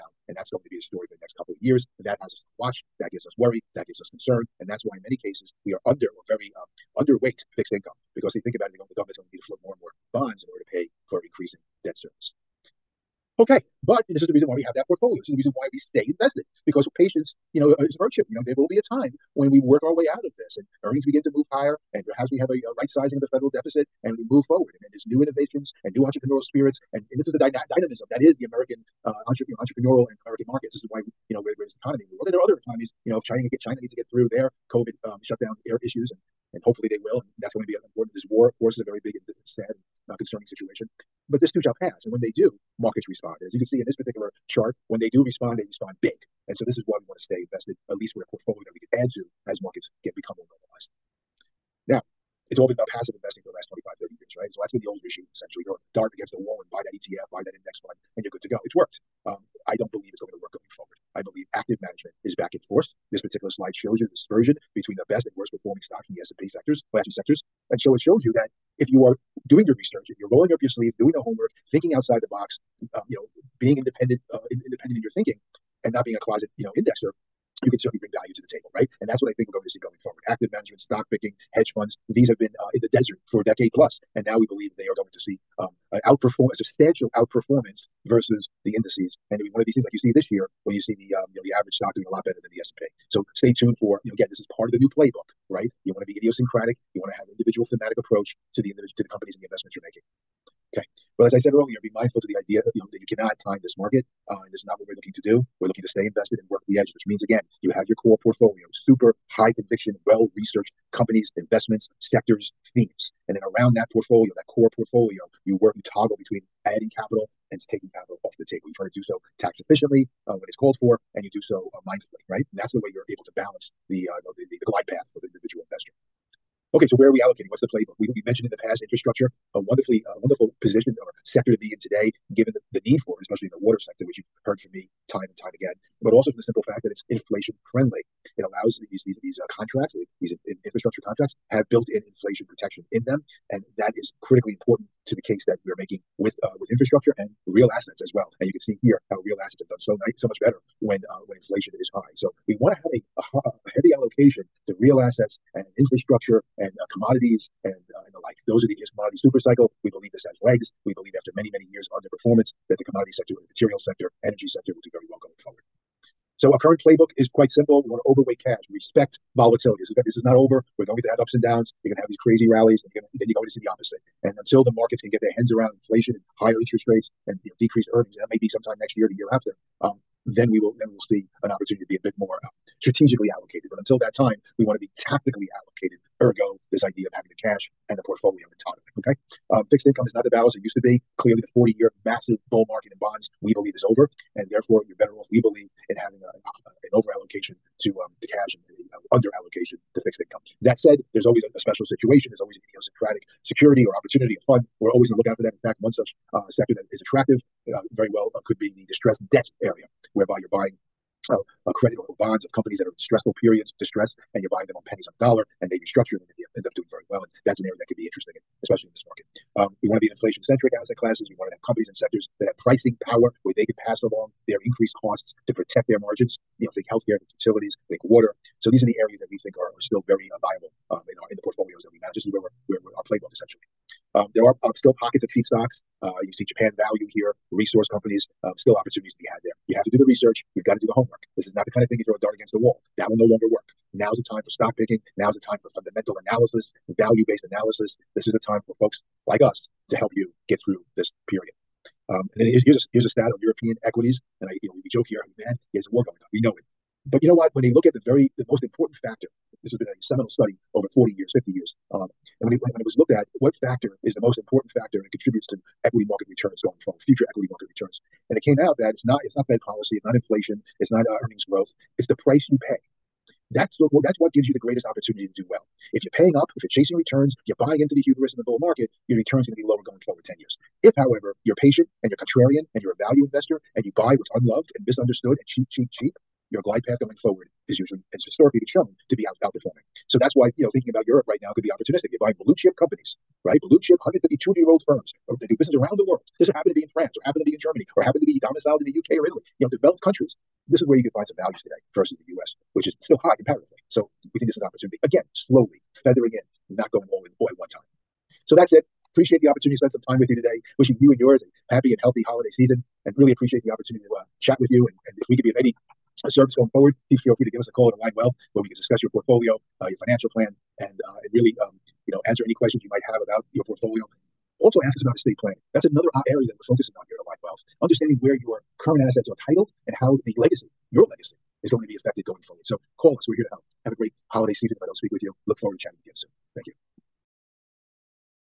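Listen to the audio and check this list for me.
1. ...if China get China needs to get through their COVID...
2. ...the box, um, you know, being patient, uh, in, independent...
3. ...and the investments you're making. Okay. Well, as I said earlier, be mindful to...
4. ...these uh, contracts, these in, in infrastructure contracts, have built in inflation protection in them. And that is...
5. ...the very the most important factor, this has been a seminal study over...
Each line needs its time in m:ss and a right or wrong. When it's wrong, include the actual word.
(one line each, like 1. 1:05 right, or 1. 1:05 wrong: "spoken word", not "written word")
1. 0:33 right
2. 1:12 wrong: "independent", not "patient"
3. 1:39 right
4. 2:19 right
5. 4:17 right.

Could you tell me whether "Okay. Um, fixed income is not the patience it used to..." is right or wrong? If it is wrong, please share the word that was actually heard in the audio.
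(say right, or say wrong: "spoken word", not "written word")
wrong: "balance", not "patience".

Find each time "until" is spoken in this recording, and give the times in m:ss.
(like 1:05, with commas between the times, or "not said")
2:54, 3:03.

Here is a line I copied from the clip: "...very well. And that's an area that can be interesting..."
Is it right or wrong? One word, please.
right.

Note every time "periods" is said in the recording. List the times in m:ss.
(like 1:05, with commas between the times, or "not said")
3:33, 4:11.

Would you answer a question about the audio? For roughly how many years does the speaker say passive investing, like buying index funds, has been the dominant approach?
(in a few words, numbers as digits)
25-30 years.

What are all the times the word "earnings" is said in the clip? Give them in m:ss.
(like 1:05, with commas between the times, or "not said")
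0:20, 2:57, 4:31.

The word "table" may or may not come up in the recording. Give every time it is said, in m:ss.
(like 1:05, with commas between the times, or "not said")
1:18, 1:58.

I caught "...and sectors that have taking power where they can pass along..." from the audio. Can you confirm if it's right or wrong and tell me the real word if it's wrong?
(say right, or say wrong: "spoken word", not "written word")
wrong: "pricing", not "taking".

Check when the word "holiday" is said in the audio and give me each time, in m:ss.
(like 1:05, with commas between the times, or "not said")
5:12, 5:34.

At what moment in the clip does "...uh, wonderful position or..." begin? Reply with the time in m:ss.
2:10.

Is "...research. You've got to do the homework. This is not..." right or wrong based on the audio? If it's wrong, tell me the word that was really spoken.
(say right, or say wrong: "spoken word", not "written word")
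right.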